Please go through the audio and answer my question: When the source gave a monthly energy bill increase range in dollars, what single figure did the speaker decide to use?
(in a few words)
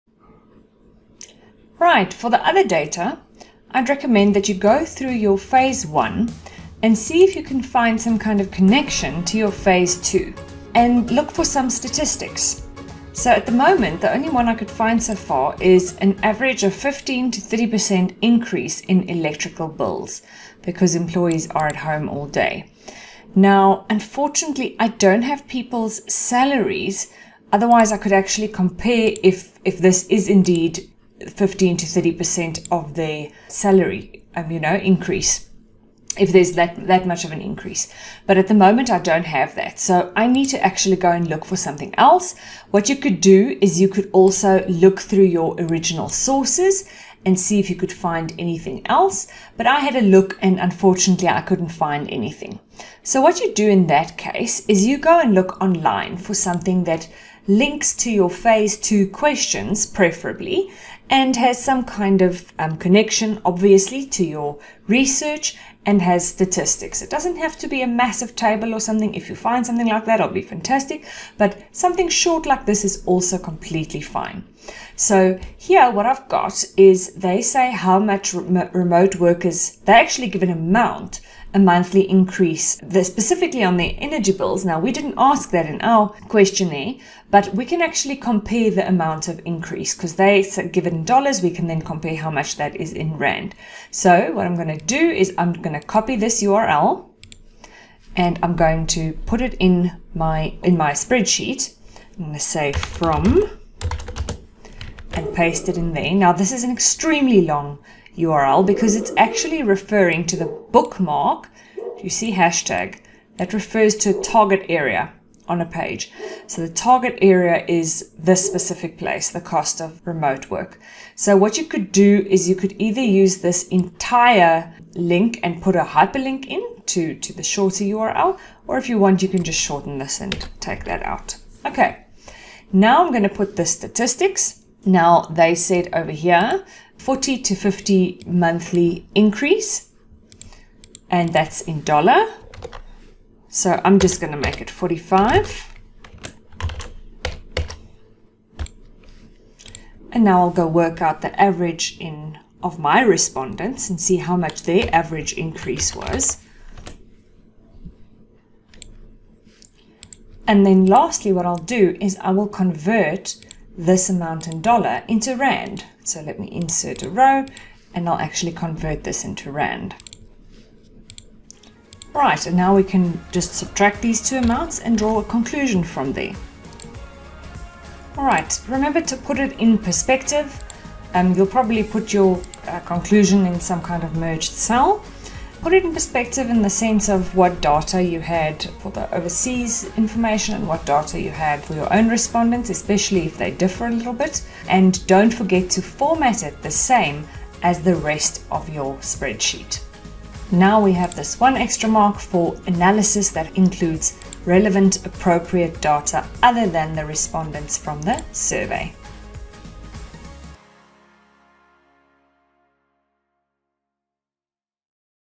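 45.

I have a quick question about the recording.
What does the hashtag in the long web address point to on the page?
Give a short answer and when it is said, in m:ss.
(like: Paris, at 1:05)
a target area, at 1:54.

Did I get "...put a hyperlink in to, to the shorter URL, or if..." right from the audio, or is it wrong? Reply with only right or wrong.
right.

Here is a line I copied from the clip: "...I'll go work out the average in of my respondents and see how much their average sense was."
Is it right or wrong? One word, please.
wrong.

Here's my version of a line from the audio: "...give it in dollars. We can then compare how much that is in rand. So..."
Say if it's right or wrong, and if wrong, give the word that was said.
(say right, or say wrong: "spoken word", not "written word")
right.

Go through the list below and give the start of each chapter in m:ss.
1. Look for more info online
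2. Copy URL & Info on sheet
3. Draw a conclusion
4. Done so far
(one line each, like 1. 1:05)
1. 0:52
2. 1:33
3. 2:57
4. 3:20.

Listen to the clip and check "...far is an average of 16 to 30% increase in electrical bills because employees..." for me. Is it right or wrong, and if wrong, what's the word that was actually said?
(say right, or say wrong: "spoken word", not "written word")
wrong: "15", not "16".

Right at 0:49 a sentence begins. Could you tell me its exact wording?
But I had a look and unfortunately I couldn't find anything.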